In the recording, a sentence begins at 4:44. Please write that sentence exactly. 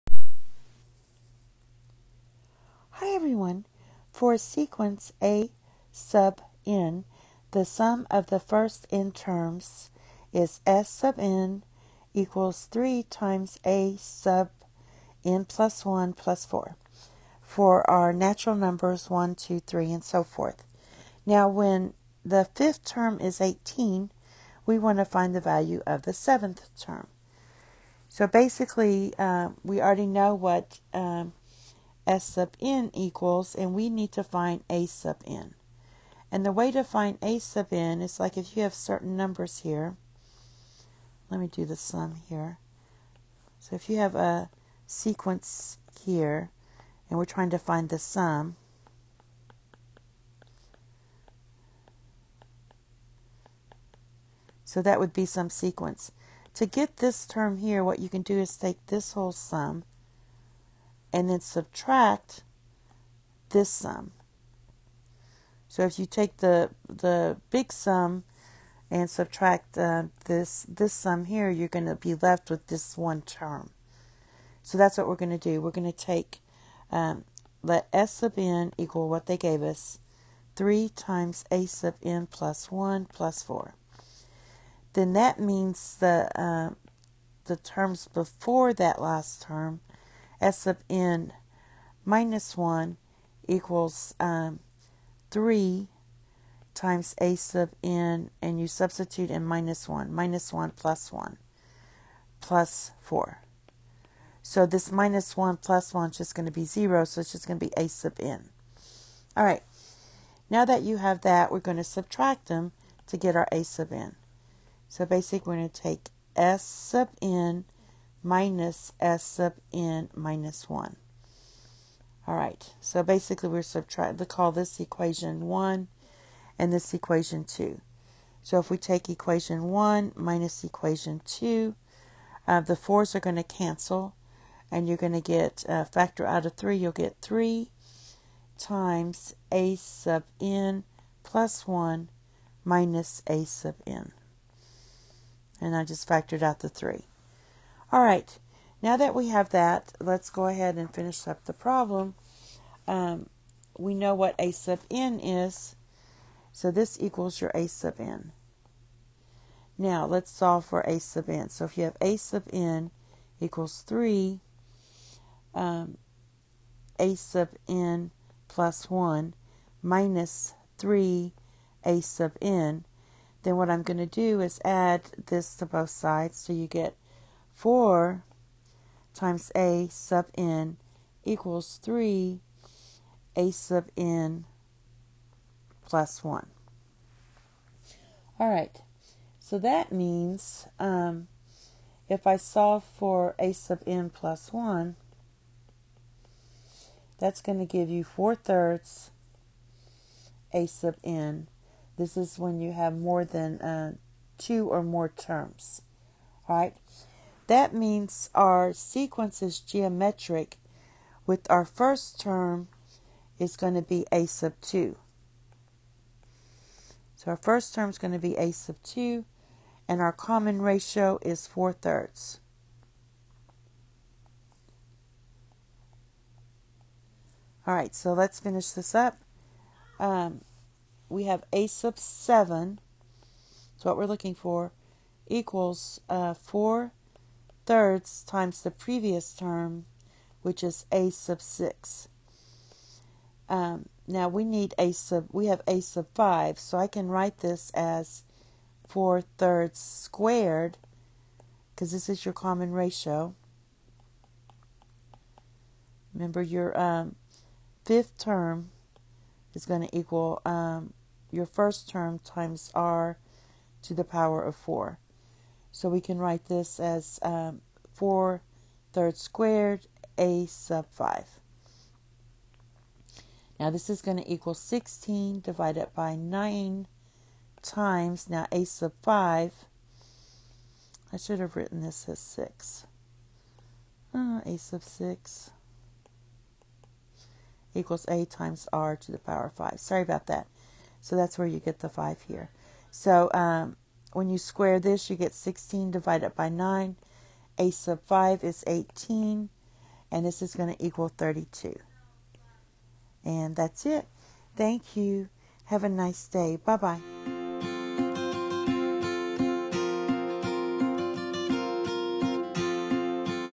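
Uh, a sub 6 equals a times r to the power of 5.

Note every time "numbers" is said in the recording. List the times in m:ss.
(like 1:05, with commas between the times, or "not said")
0:18, 0:39.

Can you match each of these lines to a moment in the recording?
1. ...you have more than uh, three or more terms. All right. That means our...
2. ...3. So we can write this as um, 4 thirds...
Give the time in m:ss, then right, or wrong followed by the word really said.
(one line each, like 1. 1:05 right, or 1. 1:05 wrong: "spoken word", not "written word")
1. 3:22 wrong: "two", not "three"
2. 4:24 wrong: "4", not "3".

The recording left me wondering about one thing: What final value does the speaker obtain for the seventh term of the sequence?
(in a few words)
32.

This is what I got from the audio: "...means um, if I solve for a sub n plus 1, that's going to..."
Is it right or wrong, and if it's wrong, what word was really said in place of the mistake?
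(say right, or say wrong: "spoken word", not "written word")
right.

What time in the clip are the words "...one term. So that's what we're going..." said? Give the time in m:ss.
1:12.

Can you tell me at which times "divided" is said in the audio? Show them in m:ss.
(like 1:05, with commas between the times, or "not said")
4:35, 4:55.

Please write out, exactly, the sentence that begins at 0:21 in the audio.
Now, when the fifth term is 18, we want to find the value of the seventh term.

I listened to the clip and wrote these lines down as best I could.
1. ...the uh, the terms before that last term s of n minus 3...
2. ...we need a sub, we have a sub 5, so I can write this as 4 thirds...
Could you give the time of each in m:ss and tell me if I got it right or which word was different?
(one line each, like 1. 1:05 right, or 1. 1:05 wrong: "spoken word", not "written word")
1. 1:25 wrong: "1", not "3"
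2. 4:04 right.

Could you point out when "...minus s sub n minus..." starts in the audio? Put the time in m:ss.
1:58.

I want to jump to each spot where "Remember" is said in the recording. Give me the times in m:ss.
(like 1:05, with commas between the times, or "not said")
4:16.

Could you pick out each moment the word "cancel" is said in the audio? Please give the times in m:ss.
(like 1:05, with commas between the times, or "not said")
2:13.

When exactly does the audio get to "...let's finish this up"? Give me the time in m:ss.
3:48.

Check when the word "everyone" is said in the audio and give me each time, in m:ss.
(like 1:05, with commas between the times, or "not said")
0:03.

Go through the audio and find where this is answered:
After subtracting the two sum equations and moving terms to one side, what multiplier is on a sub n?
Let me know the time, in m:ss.
2:57.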